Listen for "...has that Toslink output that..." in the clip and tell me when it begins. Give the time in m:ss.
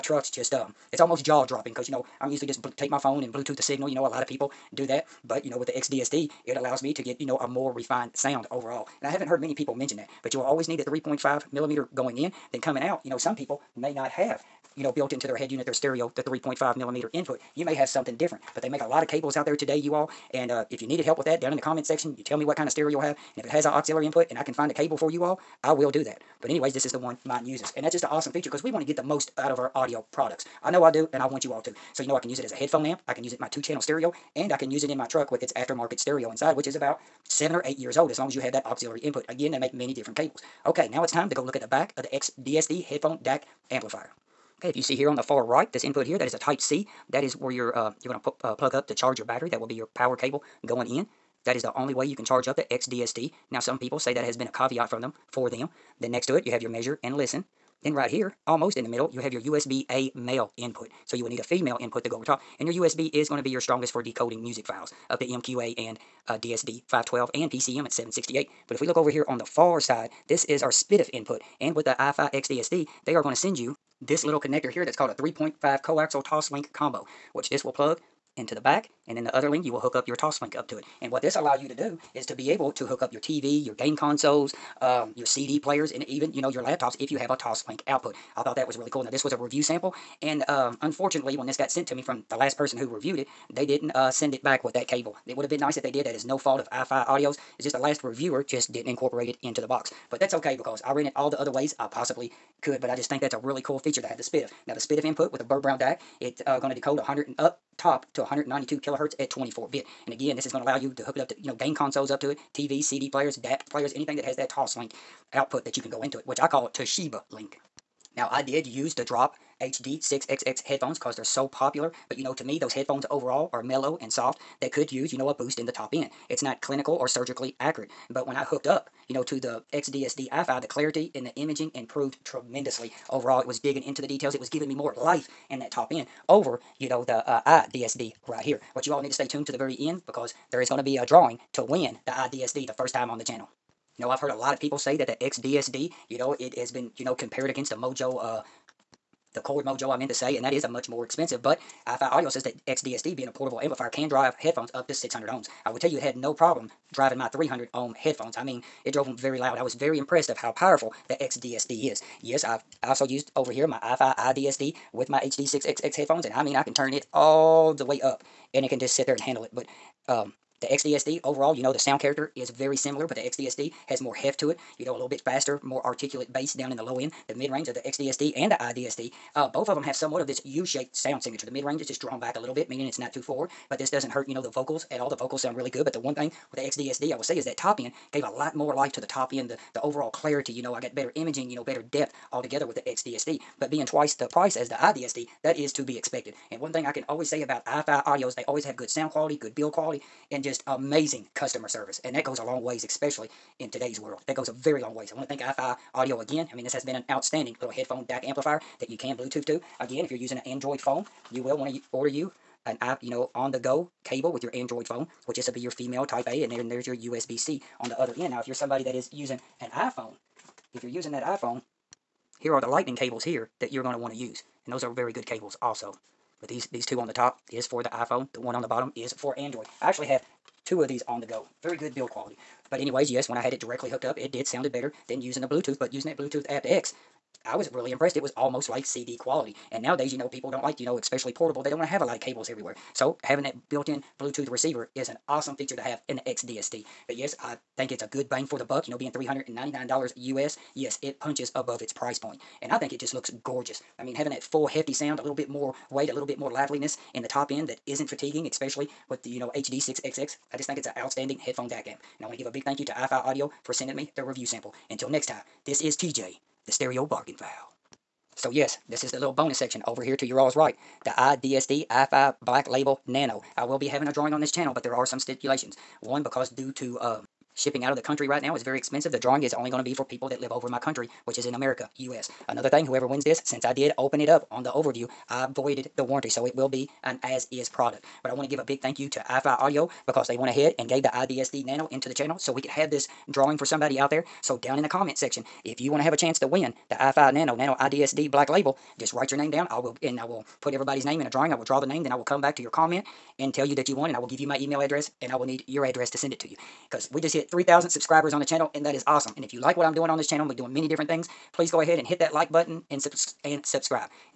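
1:54.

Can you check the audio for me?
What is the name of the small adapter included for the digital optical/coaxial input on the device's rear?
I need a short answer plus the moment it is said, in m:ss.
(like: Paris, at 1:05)
3.5 coaxial Toslink combo, at 1:15.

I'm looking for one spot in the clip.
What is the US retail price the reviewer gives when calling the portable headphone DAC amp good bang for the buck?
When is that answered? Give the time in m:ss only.
4:09.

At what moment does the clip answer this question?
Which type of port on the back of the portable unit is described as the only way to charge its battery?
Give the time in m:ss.
0:46.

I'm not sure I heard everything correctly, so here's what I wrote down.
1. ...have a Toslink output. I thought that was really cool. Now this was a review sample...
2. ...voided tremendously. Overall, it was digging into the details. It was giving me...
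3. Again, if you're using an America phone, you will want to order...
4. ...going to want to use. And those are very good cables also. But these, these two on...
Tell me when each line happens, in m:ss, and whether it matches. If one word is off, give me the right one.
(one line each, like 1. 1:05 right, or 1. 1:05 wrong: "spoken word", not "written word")
1. 1:27 right
2. 2:11 wrong: "improved", not "voided"
3. 3:29 wrong: "Android", not "America"
4. 3:43 right.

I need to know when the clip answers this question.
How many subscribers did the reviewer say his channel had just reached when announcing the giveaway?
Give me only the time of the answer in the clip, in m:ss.
5:07.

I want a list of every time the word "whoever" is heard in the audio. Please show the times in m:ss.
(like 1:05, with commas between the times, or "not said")
4:42.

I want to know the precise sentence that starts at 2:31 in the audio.
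But iFi Audio says that XDSD, being a portable amplifier, can drive headphones up to 600 ohms.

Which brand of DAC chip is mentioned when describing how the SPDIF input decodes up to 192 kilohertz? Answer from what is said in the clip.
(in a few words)
Burr Brown.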